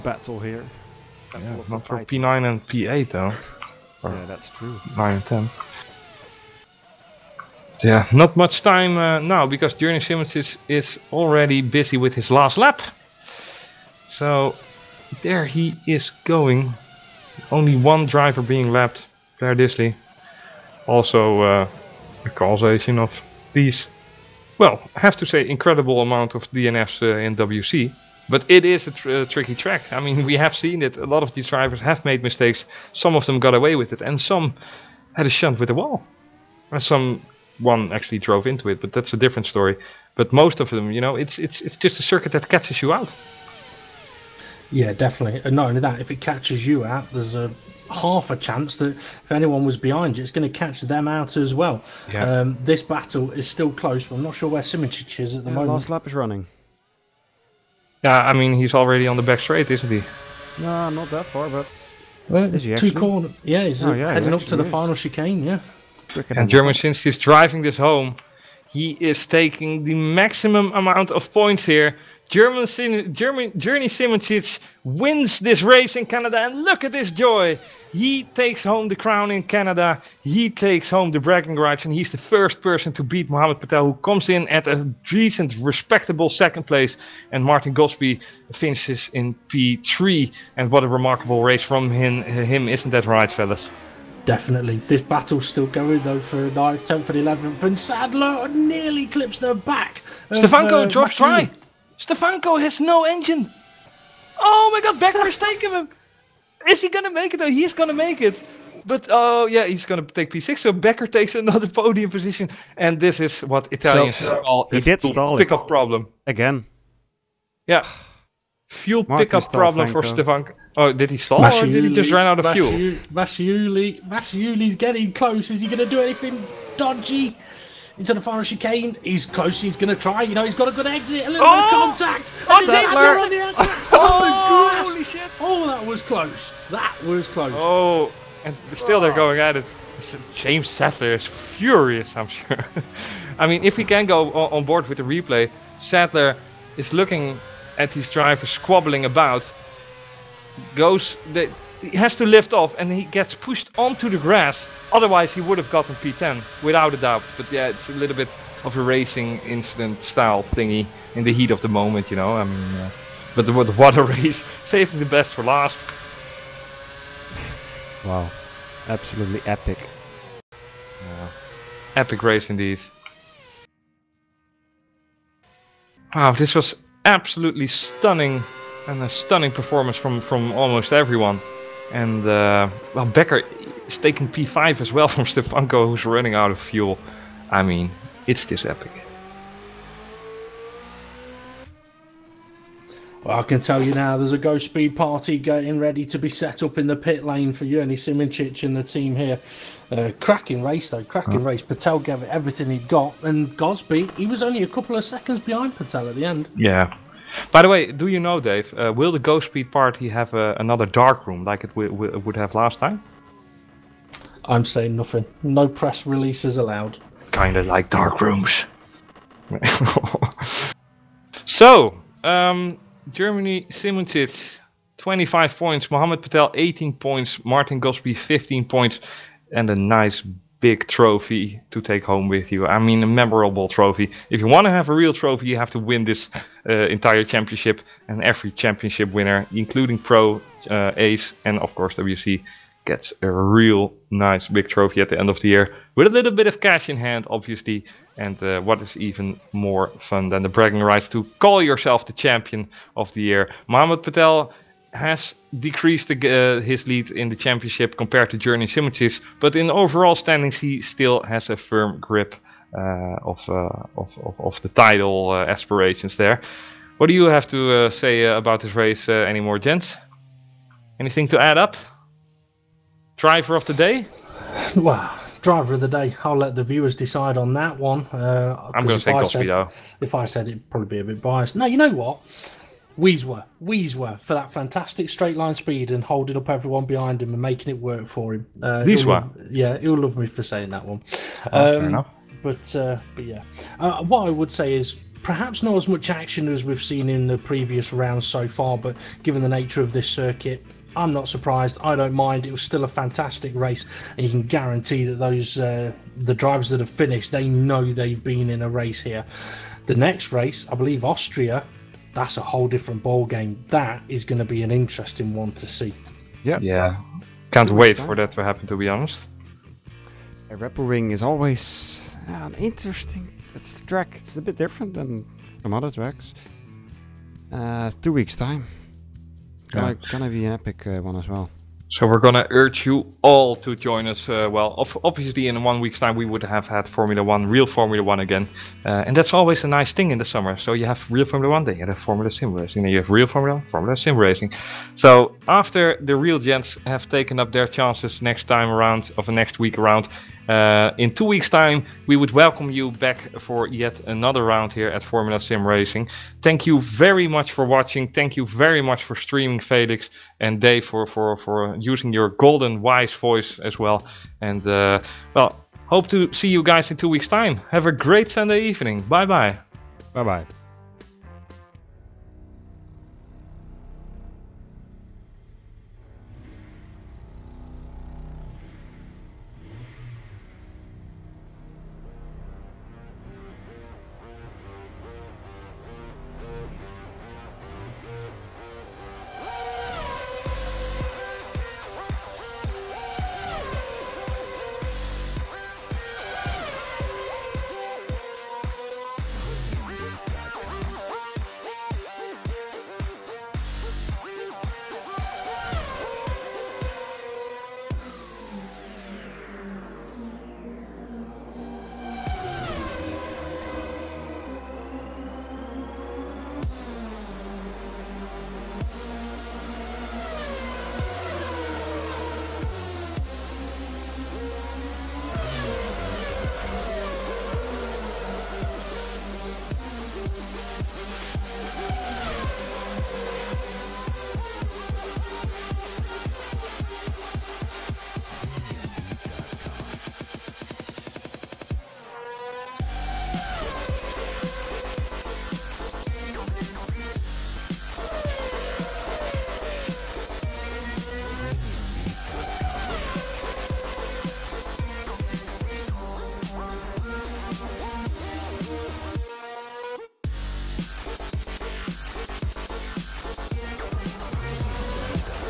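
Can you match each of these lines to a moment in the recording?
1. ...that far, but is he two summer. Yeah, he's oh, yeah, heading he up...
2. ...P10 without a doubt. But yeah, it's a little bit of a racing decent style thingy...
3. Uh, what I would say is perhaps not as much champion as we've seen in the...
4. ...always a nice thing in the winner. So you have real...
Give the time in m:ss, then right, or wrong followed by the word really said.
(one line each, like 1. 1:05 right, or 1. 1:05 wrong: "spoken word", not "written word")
1. 1:01 wrong: "corner", not "summer"
2. 2:35 wrong: "incident", not "decent"
3. 4:53 wrong: "action", not "champion"
4. 5:39 wrong: "summer", not "winner".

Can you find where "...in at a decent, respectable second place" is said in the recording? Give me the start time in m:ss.
1:24.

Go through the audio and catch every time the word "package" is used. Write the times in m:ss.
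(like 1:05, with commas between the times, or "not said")
not said.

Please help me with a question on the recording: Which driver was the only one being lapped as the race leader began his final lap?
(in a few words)
Claire Disley.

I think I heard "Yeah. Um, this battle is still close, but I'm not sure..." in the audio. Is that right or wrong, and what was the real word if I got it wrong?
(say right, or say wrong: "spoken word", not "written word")
right.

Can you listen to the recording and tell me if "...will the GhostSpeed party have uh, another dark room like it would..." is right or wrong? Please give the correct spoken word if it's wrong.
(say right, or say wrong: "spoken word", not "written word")
right.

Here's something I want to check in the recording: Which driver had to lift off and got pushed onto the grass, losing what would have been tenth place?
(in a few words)
James Sadler.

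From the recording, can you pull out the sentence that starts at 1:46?
Is he gonna make it though?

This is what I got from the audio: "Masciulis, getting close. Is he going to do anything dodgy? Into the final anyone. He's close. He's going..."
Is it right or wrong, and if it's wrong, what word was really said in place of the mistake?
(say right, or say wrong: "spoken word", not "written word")
wrong: "chicane", not "anyone".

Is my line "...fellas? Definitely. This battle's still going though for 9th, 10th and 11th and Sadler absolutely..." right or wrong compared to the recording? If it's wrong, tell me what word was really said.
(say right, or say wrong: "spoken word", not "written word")
wrong: "nearly", not "absolutely".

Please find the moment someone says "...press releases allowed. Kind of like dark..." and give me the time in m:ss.
3:35.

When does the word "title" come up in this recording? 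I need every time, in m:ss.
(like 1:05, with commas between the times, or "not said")
4:24.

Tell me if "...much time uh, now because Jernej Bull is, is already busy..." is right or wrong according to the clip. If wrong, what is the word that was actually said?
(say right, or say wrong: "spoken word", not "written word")
wrong: "Simmons", not "Bull".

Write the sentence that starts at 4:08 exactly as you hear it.
And uh, what is even more fun than the bragging rights to call yourself the champion of the year?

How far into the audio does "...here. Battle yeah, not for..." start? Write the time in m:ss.
0:00.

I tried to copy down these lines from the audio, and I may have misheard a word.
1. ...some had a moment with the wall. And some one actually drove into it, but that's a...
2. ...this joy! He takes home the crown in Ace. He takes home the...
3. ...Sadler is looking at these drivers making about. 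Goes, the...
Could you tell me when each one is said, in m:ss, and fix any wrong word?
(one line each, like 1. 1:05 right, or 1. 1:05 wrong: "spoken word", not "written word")
1. 0:34 wrong: "shunt", not "moment"
2. 1:16 wrong: "Canada", not "Ace"
3. 2:25 wrong: "squabbling", not "making".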